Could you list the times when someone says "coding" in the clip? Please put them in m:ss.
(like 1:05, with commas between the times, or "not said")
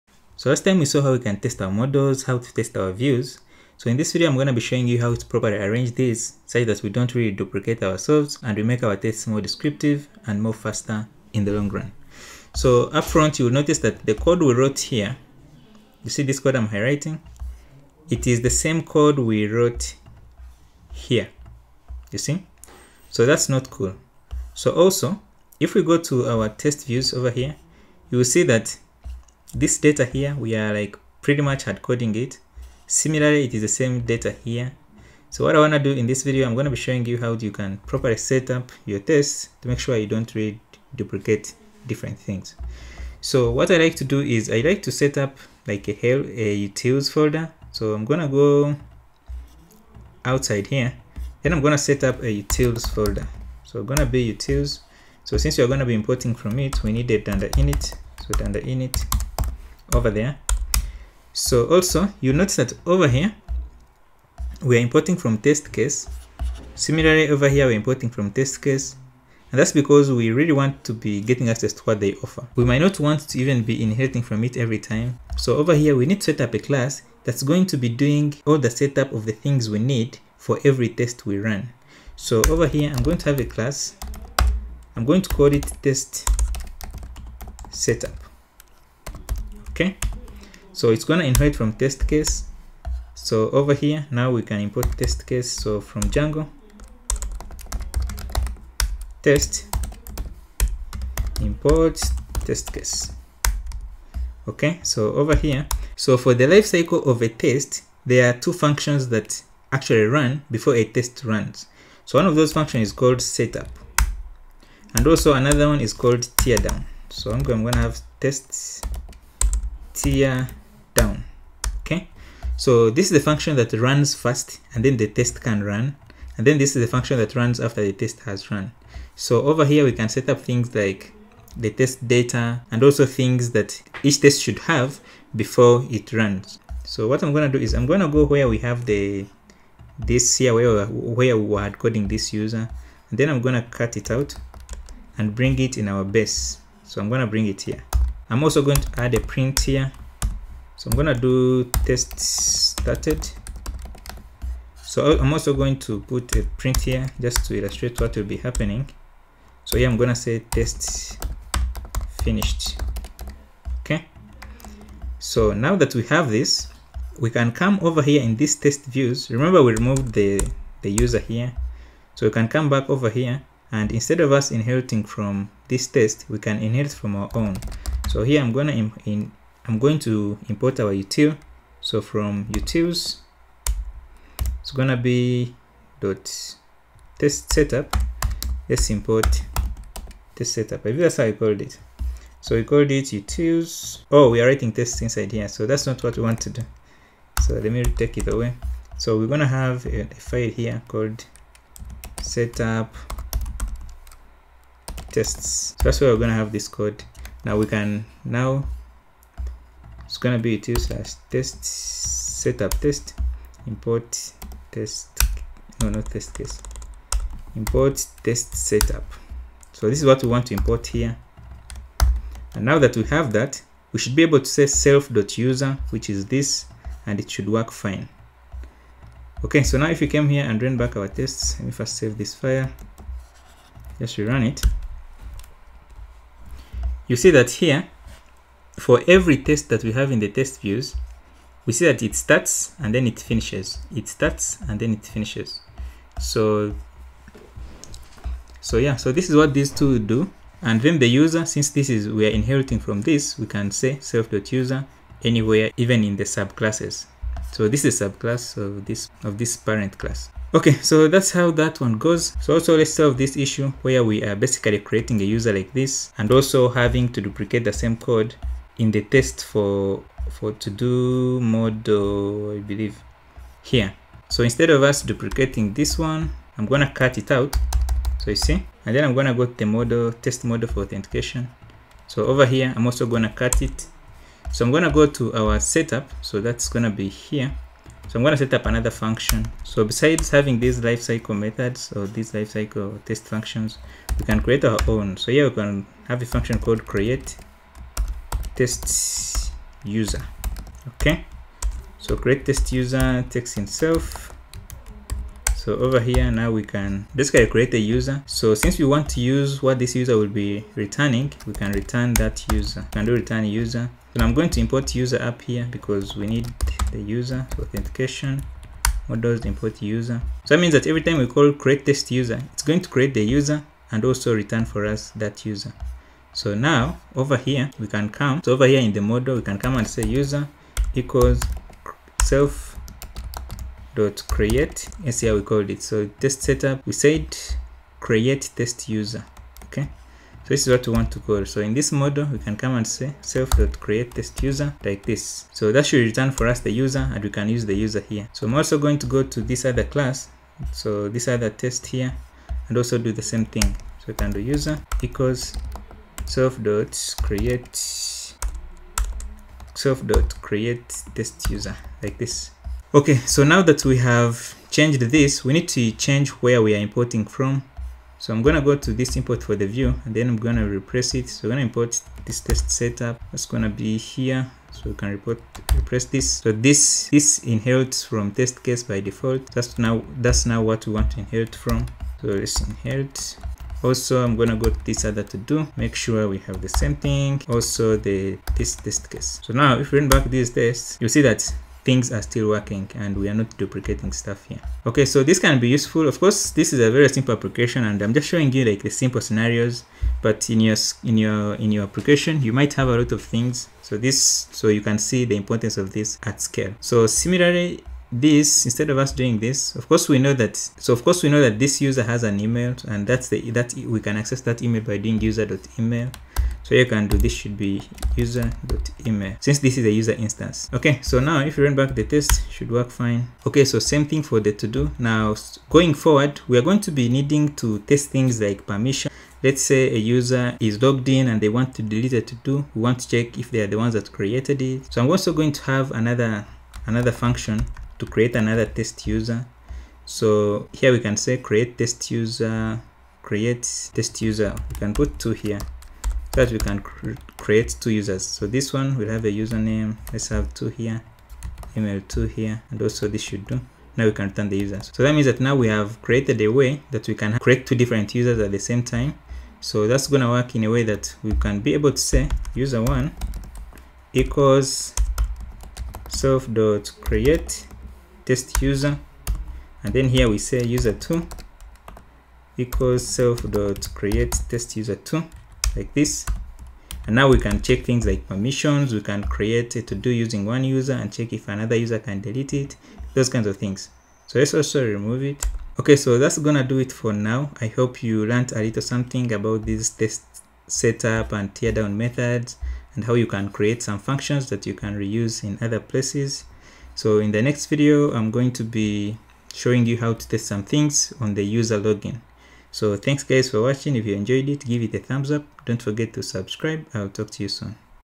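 0:31, 2:21.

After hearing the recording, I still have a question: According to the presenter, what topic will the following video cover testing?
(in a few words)
user login.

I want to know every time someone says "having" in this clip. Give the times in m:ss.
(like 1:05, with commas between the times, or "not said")
4:26, 4:50.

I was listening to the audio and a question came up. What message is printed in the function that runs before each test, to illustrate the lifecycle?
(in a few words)
test started.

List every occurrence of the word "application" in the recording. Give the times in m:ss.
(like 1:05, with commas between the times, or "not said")
6:37, 6:41.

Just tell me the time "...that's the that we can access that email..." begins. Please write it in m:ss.
6:53.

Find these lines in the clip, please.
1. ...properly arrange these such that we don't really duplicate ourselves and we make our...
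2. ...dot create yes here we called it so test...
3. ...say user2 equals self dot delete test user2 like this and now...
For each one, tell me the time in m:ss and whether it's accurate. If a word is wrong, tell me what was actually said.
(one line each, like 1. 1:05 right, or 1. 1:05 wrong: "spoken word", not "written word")
1. 0:05 right
2. 5:33 right
3. 7:50 wrong: "create", not "delete".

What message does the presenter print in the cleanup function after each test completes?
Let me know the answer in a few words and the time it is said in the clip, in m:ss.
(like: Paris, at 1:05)
test finished, at 2:40.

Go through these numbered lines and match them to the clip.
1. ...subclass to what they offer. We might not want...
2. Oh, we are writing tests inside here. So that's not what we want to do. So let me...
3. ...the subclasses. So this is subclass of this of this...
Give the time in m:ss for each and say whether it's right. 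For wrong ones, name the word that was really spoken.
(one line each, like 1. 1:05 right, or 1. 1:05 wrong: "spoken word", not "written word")
1. 1:11 wrong: "access", not "subclass"
2. 3:14 right
3. 4:16 right.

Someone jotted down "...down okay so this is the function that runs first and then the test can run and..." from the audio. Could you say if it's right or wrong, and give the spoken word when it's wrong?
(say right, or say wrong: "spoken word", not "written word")
right.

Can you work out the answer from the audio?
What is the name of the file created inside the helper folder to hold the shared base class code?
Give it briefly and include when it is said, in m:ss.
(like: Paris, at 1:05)
setup tests, at 3:22.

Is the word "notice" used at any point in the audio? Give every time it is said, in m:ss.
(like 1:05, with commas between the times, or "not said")
0:13, 1:02.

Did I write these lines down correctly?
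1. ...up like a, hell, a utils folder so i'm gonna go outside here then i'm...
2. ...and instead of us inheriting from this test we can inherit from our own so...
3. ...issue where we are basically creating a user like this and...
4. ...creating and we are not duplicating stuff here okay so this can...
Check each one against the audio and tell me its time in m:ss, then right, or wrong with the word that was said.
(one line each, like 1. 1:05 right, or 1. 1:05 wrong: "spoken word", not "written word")
1. 0:45 right
2. 2:53 right
3. 4:23 right
4. 6:32 wrong: "working", not "creating".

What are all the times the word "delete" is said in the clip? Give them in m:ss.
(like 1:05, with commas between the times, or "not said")
7:11, 8:02.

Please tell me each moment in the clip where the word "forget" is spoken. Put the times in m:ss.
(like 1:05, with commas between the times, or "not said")
8:25.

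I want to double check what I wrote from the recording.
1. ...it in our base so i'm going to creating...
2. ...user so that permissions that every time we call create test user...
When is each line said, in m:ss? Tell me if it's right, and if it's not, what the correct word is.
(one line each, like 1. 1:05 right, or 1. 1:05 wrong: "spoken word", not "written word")
1. 2:25 wrong: "bring", not "creating"
2. 5:19 wrong: "means", not "permissions".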